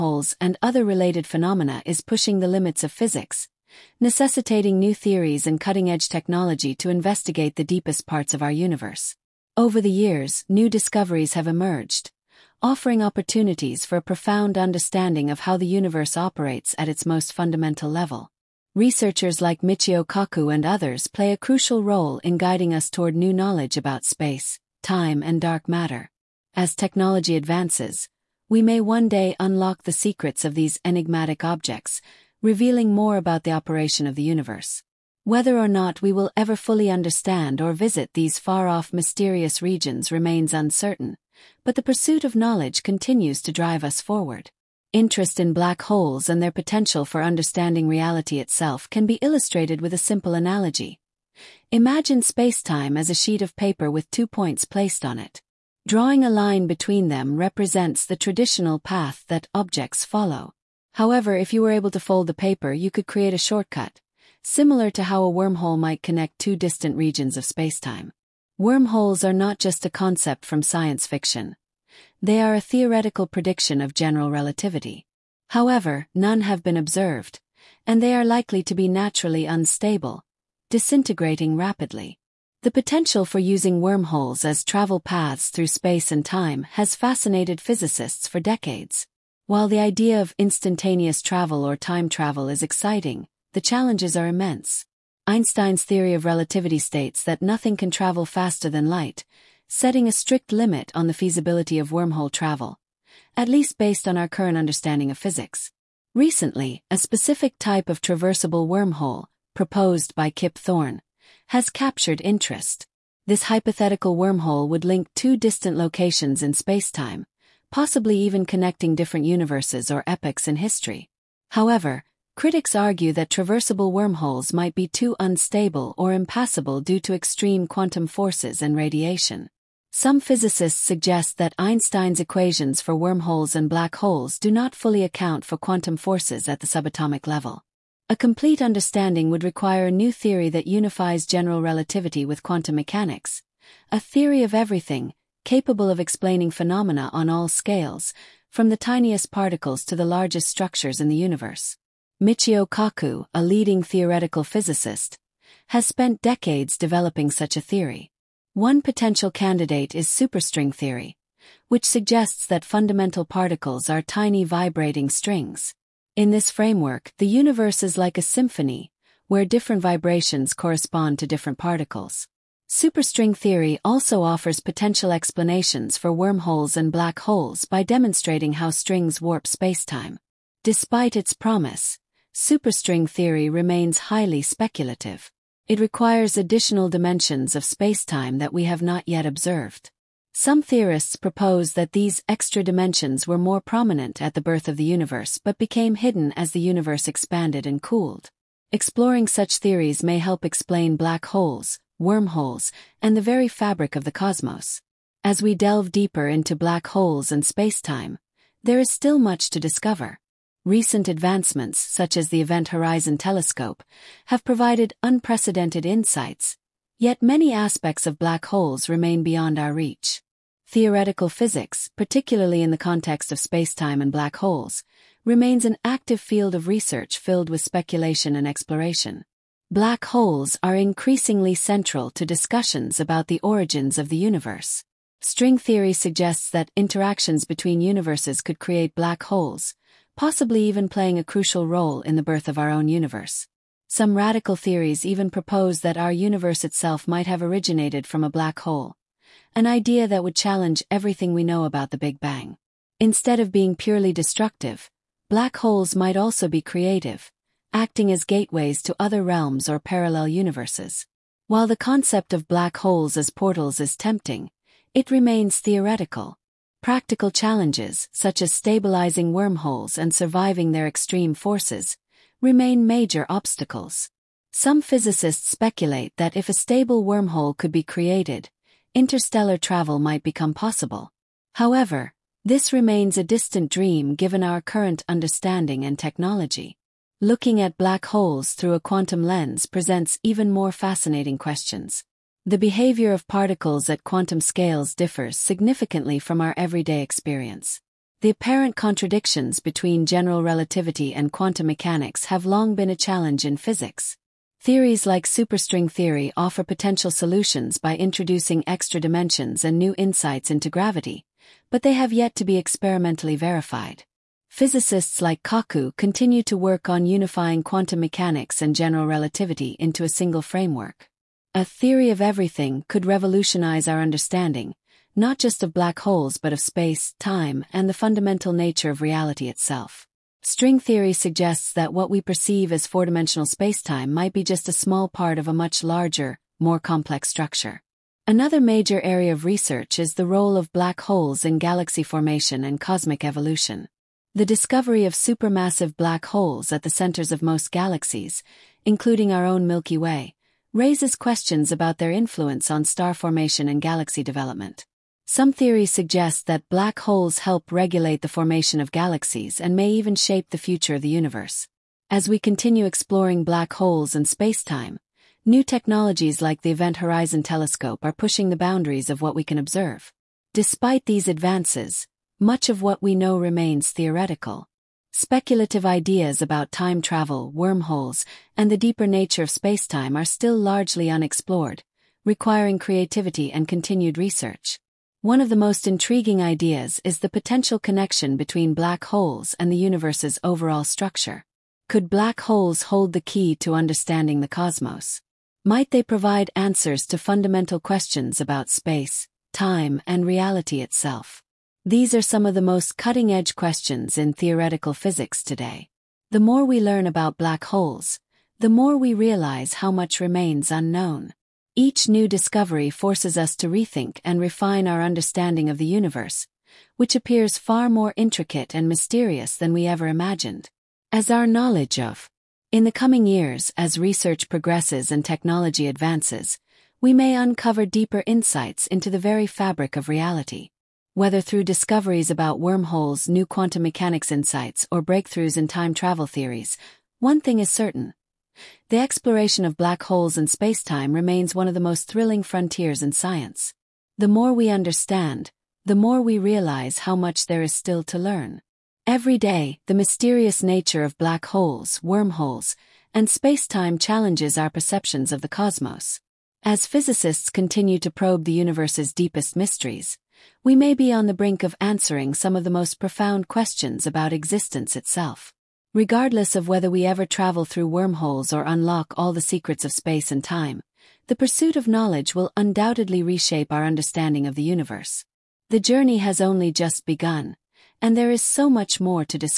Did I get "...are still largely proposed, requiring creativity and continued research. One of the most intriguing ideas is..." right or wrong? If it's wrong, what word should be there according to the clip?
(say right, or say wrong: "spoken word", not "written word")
wrong: "unexplored", not "proposed".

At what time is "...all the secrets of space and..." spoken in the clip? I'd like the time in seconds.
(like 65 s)
469 s.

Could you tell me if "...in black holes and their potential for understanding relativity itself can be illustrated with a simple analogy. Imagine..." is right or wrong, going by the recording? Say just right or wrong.
wrong.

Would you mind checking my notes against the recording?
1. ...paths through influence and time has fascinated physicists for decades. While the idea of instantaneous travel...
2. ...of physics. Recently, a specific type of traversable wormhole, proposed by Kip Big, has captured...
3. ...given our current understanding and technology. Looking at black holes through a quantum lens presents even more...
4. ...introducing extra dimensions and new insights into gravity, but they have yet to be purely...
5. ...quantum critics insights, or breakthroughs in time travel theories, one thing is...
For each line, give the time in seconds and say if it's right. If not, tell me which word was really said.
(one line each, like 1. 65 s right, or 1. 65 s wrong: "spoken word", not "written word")
1. 84 s wrong: "space", not "influence"
2. 105 s wrong: "Thorne", not "Big"
3. 284 s right
4. 307 s wrong: "experimentally", not "purely"
5. 433 s wrong: "mechanics", not "critics".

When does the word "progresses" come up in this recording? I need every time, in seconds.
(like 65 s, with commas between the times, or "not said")
424 s.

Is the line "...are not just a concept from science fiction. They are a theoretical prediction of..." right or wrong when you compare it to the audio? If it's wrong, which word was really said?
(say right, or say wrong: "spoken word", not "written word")
right.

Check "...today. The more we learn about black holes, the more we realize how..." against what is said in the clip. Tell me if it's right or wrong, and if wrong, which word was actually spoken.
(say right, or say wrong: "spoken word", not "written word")
right.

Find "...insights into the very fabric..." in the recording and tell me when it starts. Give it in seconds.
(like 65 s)
428 s.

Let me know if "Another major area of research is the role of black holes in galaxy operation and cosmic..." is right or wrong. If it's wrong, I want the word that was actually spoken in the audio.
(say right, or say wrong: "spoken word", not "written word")
wrong: "formation", not "operation".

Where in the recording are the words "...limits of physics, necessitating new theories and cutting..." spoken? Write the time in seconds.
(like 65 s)
2 s.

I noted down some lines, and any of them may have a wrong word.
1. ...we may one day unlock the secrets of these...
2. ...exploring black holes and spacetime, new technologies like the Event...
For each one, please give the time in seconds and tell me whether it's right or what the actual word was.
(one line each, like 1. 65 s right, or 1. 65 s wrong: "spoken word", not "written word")
1. 28 s right
2. 362 s right.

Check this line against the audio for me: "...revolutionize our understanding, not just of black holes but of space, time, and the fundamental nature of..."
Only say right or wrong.
right.